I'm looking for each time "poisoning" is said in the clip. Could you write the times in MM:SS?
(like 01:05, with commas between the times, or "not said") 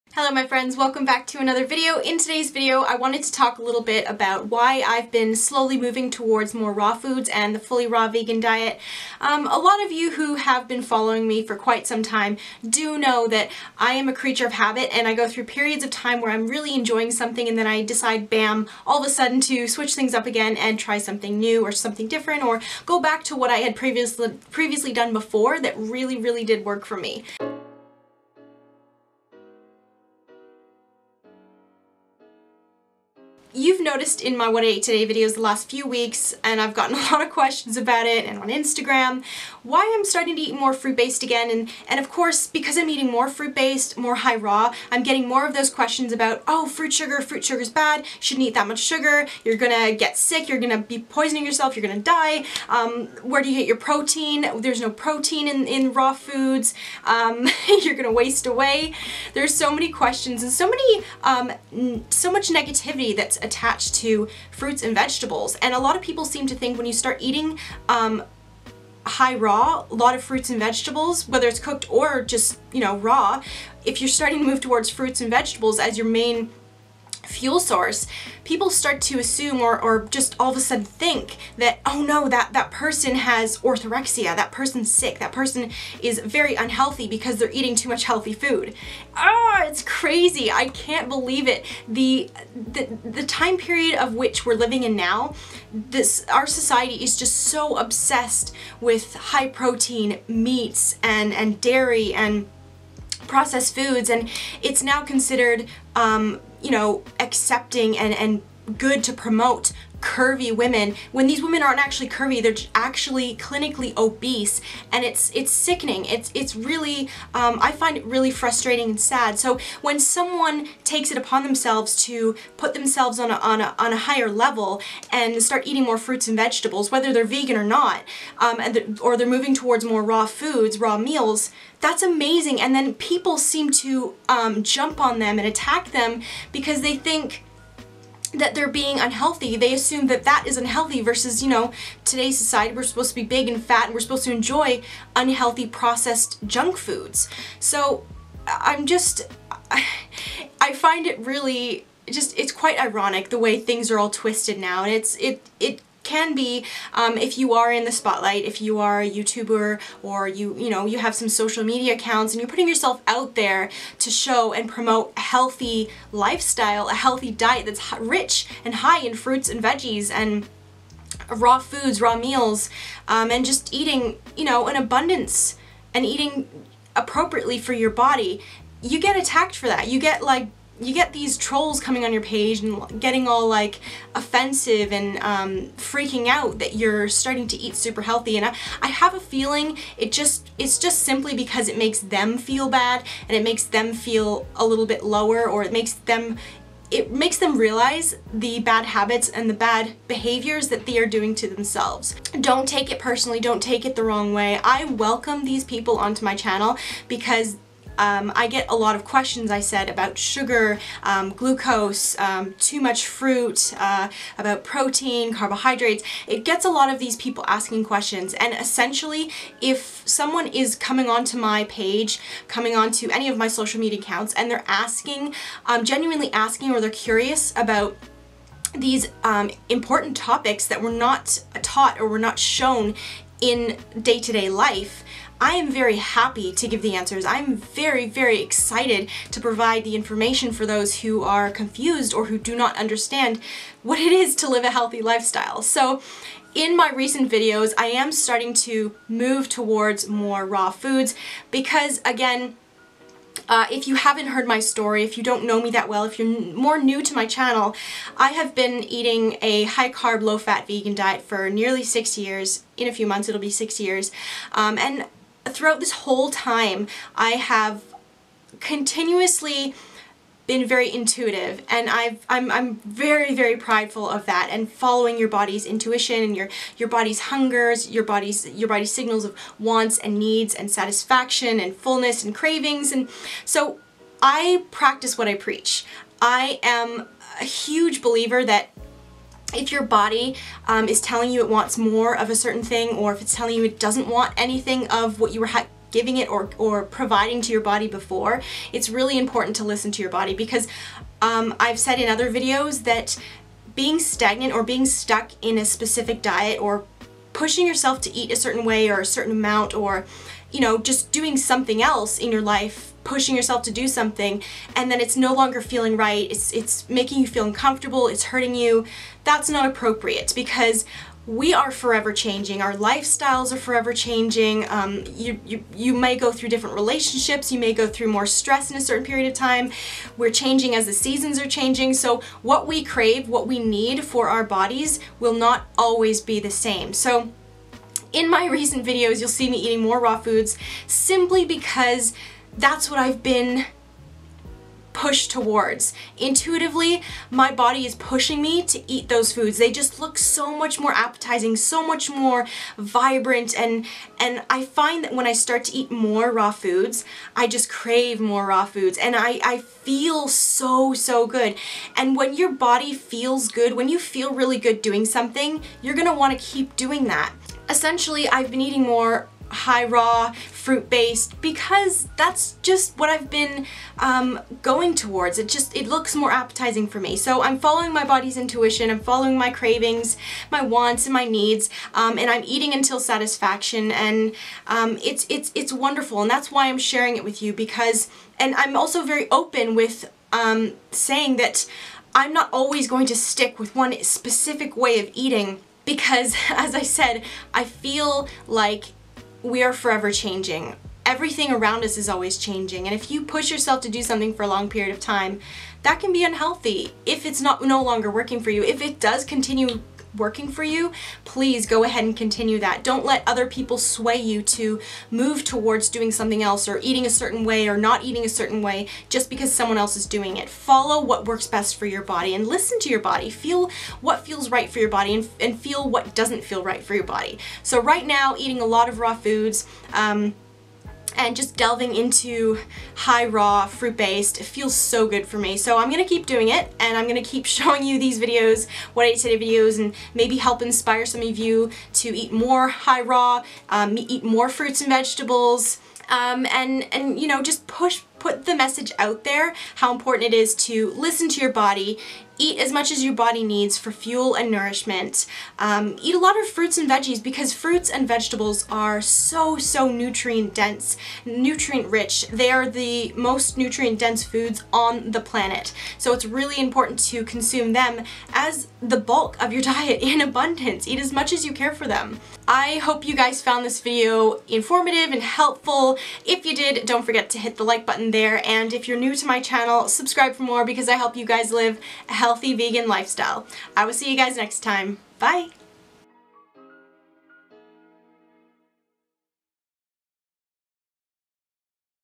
00:50.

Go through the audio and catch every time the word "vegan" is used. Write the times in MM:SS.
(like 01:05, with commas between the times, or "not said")
00:08, 02:07, 04:20, 08:02.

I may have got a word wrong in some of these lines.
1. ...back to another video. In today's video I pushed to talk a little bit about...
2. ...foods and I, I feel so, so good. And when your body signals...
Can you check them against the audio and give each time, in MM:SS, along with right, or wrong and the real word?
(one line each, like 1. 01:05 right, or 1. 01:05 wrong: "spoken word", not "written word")
1. 00:01 wrong: "wanted", not "pushed"
2. 05:58 wrong: "feels", not "signals".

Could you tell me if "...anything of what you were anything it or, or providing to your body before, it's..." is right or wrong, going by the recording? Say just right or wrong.
wrong.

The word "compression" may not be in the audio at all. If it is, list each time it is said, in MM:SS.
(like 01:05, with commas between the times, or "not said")
not said.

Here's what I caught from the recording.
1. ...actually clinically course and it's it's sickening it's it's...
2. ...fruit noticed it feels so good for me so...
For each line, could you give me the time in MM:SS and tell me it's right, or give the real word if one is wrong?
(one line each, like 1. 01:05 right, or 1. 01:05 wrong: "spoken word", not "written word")
1. 01:52 wrong: "obese", not "course"
2. 07:13 wrong: "based", not "noticed".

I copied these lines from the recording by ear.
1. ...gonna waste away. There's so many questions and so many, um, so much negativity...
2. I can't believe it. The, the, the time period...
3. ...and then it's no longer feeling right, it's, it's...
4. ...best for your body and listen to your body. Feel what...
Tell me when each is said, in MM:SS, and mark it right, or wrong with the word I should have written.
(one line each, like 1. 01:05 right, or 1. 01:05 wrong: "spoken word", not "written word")
1. 00:57 right
2. 01:30 right
3. 05:14 right
4. 07:01 right.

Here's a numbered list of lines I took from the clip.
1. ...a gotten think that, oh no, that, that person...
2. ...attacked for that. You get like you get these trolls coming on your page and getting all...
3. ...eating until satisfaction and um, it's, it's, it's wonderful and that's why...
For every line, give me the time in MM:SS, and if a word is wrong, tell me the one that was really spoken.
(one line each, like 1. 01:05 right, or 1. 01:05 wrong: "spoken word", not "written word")
1. 01:20 wrong: "sudden", not "gotten"
2. 02:59 right
3. 06:22 right.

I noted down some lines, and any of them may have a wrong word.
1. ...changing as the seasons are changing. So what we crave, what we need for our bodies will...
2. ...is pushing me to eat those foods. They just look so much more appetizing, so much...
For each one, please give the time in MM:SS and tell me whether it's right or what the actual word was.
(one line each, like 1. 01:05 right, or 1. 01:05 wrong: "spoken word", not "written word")
1. 05:30 right
2. 05:47 right.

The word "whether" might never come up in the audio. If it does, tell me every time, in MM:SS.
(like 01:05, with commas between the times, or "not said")
01:11, 02:06.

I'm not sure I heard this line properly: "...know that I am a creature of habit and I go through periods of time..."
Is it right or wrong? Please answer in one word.
right.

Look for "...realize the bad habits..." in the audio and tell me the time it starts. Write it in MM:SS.
03:17.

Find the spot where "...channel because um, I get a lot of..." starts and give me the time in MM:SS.
03:26.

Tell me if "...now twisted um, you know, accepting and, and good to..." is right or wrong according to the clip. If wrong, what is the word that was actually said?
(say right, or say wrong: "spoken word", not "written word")
wrong: "considered", not "twisted".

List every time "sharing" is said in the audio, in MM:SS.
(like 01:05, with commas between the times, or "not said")
06:26.